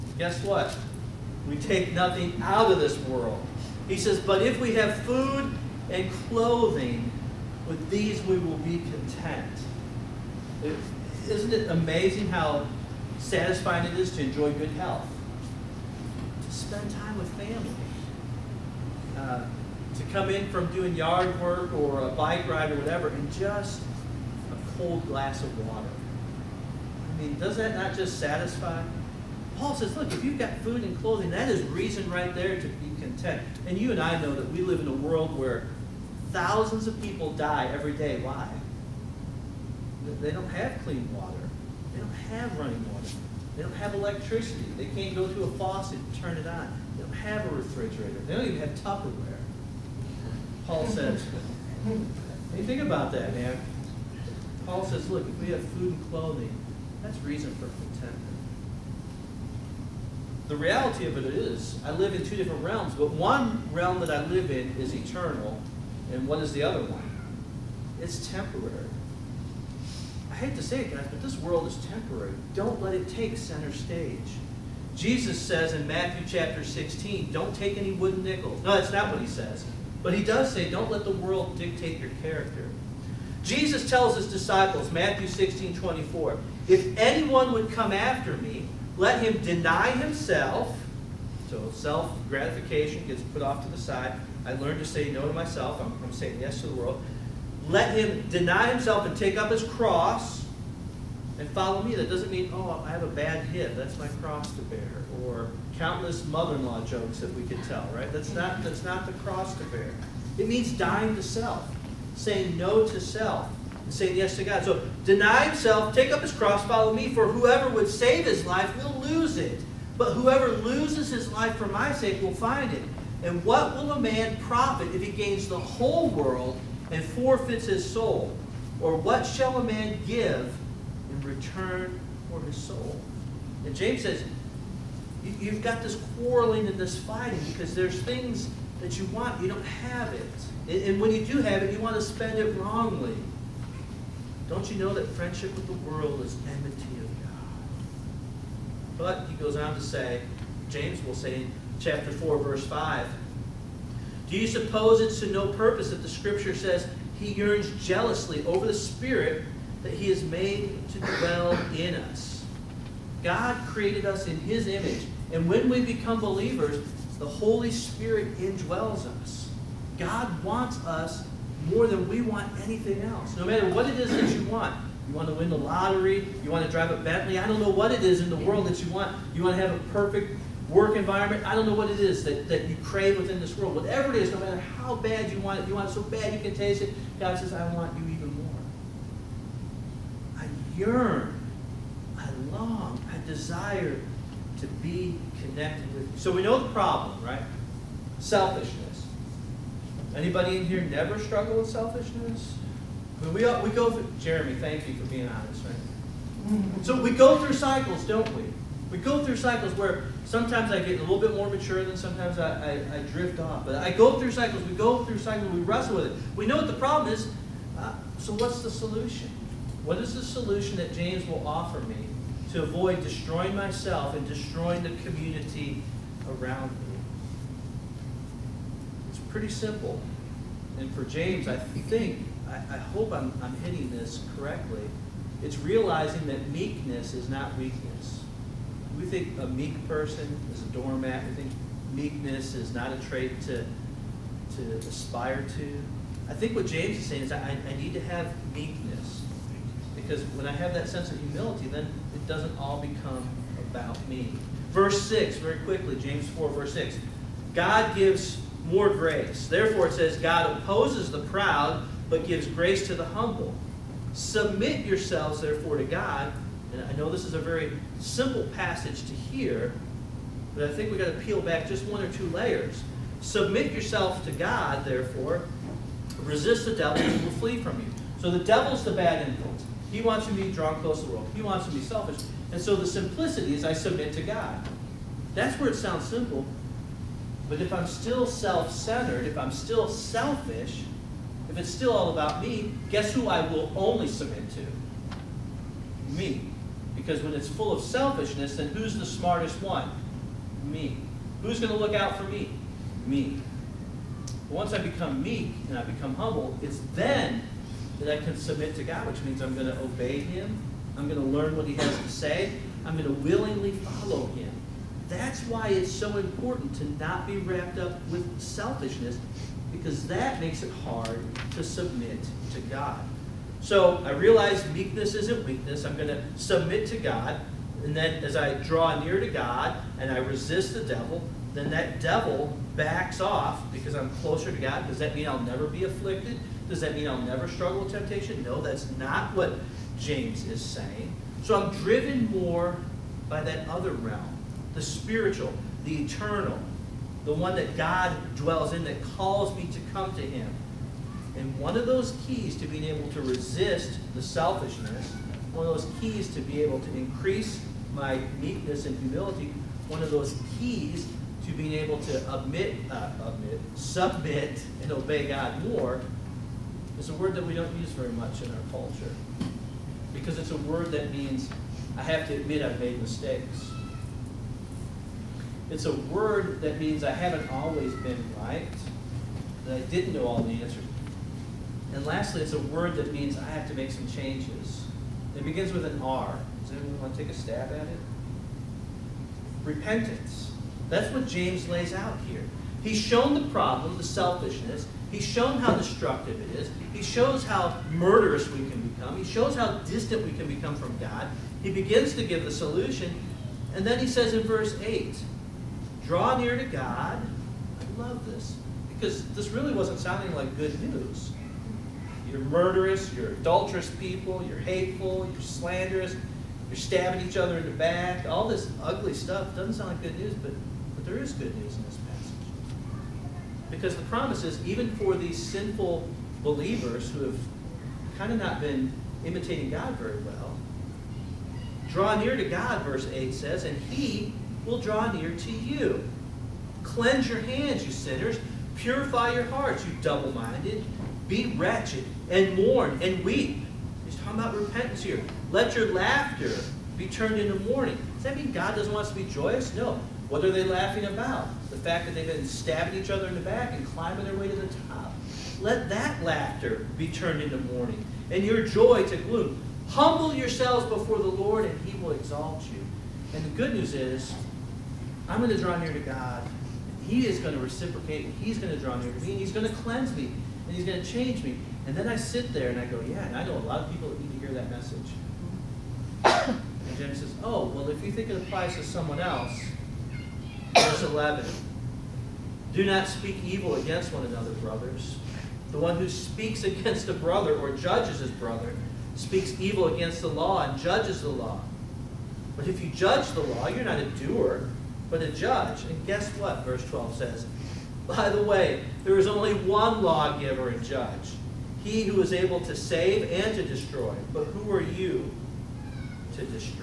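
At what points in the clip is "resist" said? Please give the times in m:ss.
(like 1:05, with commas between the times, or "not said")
4:36, 5:30, 5:53.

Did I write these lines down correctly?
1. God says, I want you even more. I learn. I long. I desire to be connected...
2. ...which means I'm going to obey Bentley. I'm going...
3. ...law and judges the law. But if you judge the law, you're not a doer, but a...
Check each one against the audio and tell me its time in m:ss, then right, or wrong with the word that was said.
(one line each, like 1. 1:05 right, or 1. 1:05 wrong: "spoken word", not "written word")
1. 3:07 wrong: "yearn", not "learn"
2. 5:09 wrong: "Him", not "Bentley"
3. 8:10 right.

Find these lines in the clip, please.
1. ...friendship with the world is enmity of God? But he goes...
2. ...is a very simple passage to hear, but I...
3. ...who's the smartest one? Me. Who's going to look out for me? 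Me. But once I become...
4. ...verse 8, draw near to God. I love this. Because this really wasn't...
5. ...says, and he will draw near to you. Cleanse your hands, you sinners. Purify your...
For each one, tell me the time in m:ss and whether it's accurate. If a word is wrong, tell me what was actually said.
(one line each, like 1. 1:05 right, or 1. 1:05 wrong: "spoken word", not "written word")
1. 2:25 right
2. 4:27 right
3. 4:58 right
4. 6:44 right
5. 7:13 right.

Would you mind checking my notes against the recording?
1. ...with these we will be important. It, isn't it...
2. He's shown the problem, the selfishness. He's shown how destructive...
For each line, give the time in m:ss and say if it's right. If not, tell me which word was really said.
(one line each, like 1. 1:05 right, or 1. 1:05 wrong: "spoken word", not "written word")
1. 0:07 wrong: "content", not "important"
2. 6:32 right.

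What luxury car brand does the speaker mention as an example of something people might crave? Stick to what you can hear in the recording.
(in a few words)
Bentley.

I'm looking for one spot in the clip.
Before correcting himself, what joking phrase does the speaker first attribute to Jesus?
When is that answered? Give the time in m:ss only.
1:17.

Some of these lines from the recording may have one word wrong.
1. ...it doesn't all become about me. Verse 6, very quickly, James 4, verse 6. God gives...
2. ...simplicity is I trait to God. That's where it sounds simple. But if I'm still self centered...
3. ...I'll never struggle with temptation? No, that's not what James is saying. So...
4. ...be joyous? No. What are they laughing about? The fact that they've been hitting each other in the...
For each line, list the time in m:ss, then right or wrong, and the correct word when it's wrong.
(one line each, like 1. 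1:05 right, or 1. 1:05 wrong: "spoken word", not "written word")
1. 4:12 right
2. 4:42 wrong: "submit", not "trait"
3. 5:37 right
4. 7:29 wrong: "stabbing", not "hitting".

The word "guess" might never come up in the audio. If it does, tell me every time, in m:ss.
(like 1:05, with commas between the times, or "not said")
0:00, 4:52, 8:16.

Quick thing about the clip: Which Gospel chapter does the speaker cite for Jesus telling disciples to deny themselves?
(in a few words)
Matthew 16.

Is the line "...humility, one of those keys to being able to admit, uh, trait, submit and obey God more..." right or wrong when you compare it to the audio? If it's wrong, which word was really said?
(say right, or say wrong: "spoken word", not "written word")
wrong: "admit", not "trait".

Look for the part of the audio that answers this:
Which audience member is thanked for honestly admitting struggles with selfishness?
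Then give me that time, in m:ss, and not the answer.
3:24.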